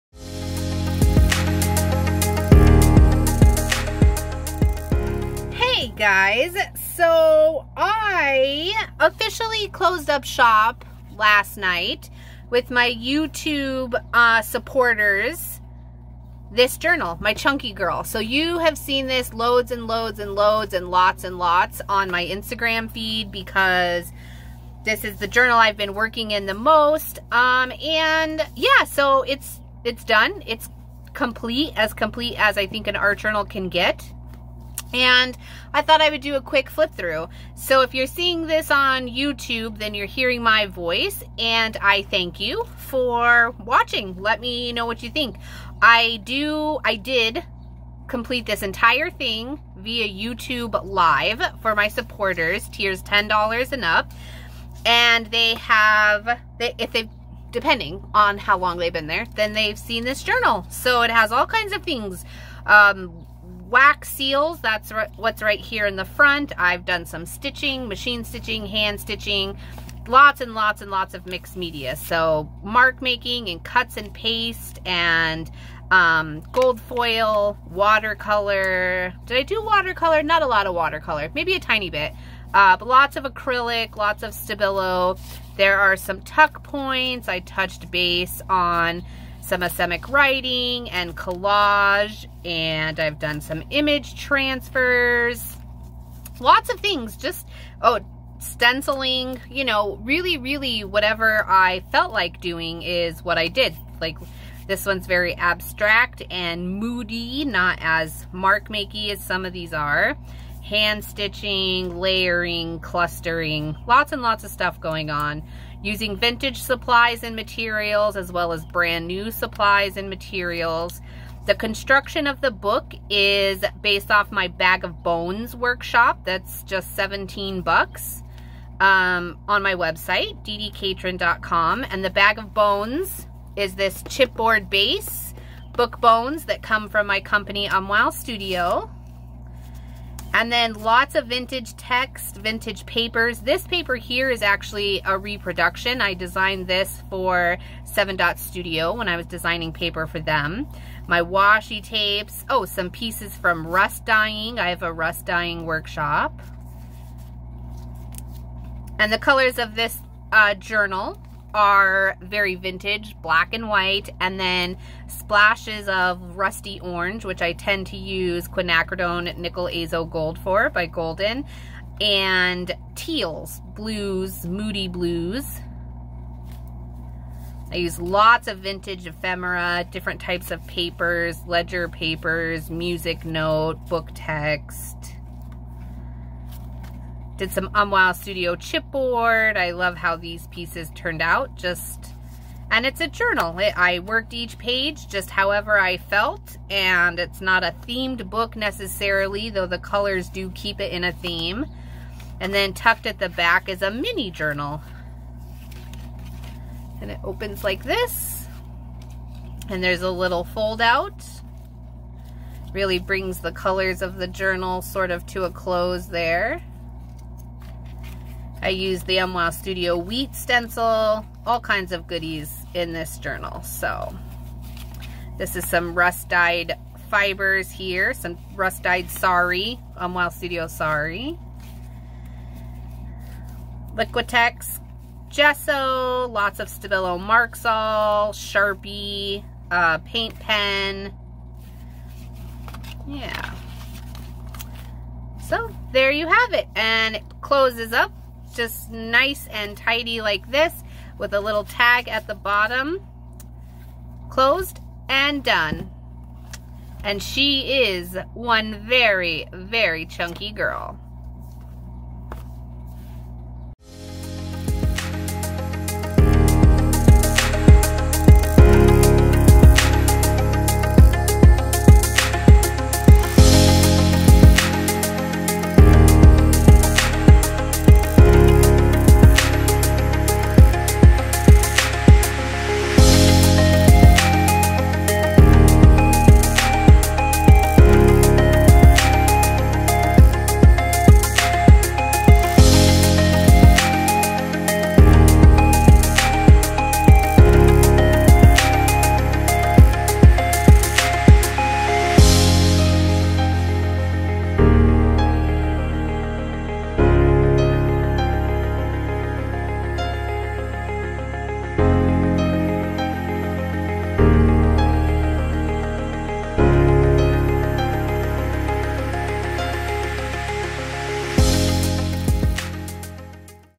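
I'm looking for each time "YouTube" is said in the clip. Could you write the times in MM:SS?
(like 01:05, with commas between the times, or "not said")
00:12, 00:39, 00:50.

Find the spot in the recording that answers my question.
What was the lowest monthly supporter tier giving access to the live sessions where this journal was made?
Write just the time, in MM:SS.
00:53.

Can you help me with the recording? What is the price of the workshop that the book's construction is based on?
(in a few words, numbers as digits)
$17.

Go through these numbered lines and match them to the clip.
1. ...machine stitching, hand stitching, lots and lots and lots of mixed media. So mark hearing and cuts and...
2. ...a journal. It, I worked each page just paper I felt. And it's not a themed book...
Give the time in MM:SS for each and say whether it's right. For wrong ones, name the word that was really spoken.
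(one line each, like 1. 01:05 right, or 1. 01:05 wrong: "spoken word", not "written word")
1. 01:07 wrong: "making", not "hearing"
2. 03:13 wrong: "however", not "paper".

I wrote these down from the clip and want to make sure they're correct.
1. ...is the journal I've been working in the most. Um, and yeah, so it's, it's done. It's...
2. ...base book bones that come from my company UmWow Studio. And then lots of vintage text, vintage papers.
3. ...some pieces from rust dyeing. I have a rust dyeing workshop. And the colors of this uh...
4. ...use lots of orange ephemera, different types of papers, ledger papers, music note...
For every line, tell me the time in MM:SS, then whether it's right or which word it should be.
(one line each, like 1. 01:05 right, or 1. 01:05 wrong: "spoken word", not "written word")
1. 00:25 right
2. 02:14 right
3. 02:32 right
4. 02:57 wrong: "vintage", not "orange".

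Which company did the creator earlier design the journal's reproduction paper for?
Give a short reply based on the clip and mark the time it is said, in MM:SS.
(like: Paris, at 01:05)
Seven Dot Studio, at 02:27.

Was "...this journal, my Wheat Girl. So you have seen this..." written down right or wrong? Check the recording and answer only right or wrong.
wrong.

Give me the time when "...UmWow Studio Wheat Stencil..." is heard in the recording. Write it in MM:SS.
03:39.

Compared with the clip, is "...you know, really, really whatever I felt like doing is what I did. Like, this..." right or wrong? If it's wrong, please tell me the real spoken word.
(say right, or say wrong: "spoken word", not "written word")
right.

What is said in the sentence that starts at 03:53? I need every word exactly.
Liquitex gesso, lots of Stabilo Marks-All, Sharpie, uh, paint pen.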